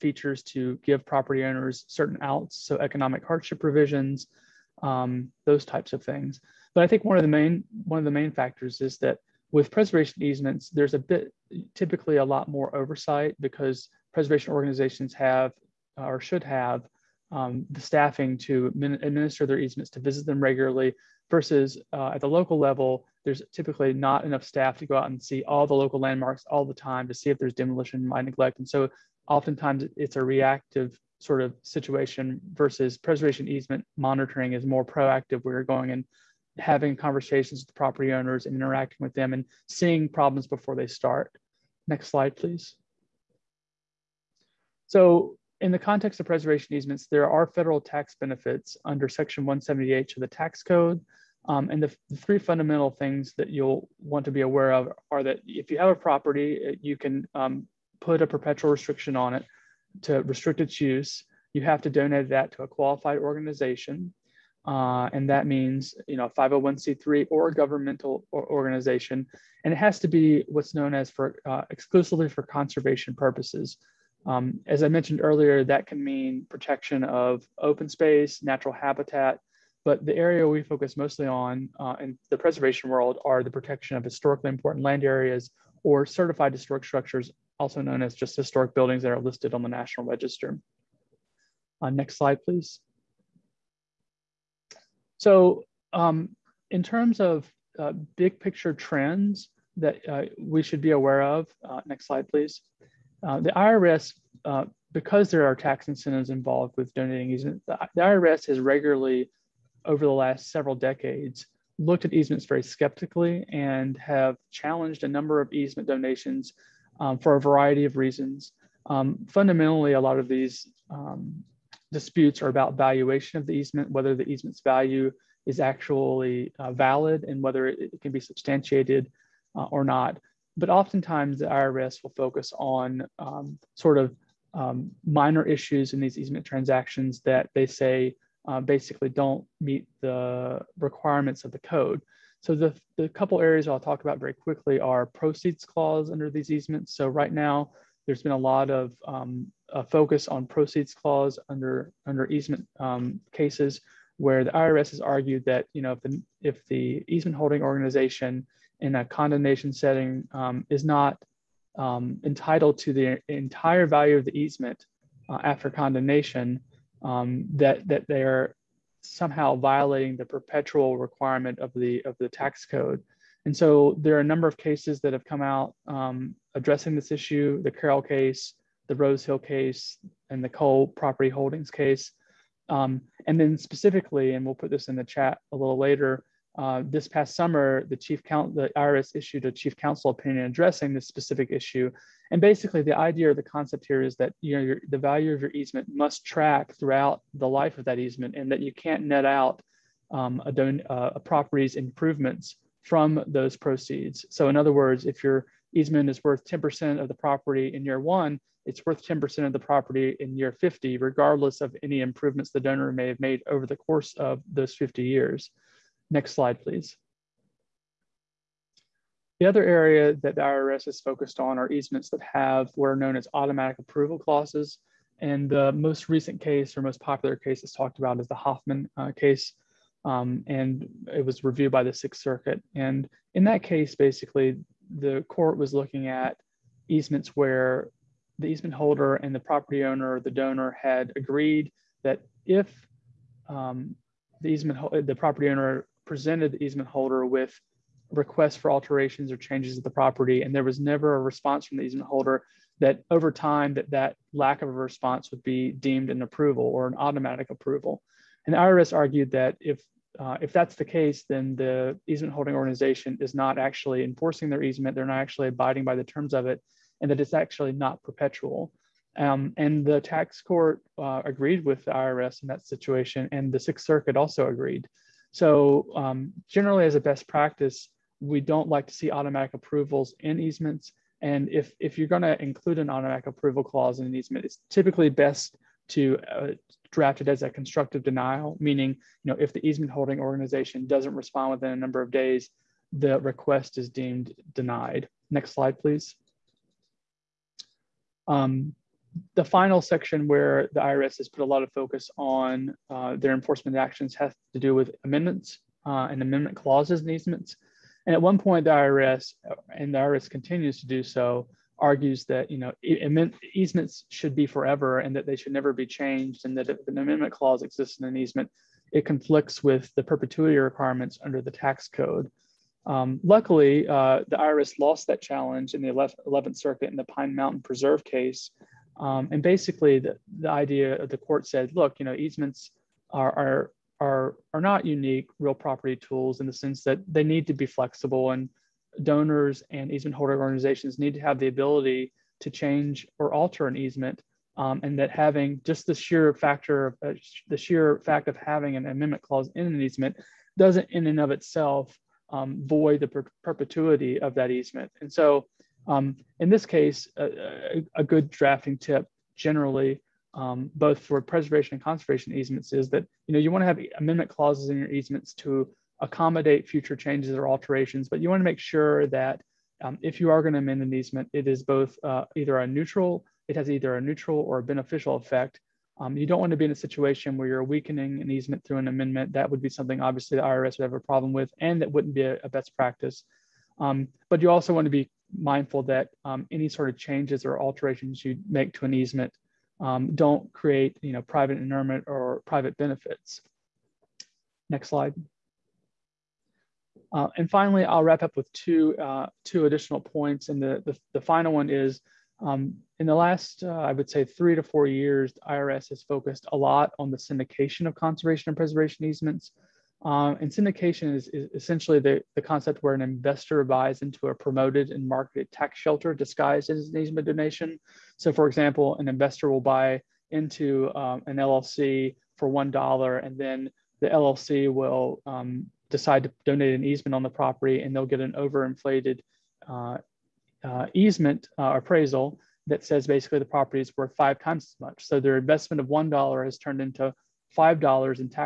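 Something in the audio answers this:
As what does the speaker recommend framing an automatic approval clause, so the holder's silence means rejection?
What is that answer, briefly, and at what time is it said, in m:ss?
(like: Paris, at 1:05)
constructive denial, at 4:47.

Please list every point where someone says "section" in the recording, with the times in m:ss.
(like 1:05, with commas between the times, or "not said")
0:49, 4:59.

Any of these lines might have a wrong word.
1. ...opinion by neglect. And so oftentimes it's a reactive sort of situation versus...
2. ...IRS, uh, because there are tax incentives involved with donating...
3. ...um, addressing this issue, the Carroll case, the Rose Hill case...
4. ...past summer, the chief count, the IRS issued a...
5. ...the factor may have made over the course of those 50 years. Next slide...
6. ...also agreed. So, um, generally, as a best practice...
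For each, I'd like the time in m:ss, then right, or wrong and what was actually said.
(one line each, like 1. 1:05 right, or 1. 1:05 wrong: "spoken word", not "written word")
1. 0:27 wrong: "demolition", not "opinion"
2. 1:43 right
3. 2:55 right
4. 3:07 right
5. 3:32 wrong: "donor", not "factor"
6. 4:34 right.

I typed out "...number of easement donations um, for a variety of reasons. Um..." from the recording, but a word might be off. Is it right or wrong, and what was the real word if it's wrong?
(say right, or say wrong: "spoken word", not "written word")
right.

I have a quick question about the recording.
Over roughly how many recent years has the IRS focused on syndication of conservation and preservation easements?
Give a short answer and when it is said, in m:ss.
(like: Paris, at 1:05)
3 to 4 years, at 6:44.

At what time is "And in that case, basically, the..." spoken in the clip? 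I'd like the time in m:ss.
3:52.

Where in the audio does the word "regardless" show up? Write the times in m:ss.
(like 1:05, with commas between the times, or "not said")
3:30.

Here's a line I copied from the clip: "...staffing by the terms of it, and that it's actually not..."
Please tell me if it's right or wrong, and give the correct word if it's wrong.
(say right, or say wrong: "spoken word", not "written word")
wrong: "abiding", not "staffing".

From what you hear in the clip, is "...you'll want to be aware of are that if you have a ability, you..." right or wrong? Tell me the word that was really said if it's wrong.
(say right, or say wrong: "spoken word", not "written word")
wrong: "property", not "ability".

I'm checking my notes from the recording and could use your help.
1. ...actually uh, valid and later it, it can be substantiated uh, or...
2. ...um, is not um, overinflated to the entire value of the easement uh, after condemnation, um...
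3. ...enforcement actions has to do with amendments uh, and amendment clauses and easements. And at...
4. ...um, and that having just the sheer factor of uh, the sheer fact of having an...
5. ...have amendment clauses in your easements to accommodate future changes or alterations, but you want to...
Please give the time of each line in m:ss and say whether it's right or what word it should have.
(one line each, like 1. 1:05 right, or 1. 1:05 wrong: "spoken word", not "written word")
1. 2:05 wrong: "whether", not "later"
2. 2:40 wrong: "entitled", not "overinflated"
3. 5:03 right
4. 5:44 right
5. 6:03 right.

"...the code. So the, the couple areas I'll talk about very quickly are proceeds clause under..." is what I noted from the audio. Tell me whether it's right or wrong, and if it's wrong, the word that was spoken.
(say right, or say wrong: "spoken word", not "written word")
right.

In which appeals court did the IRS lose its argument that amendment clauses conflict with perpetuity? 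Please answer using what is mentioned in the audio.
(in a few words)
11th Circuit.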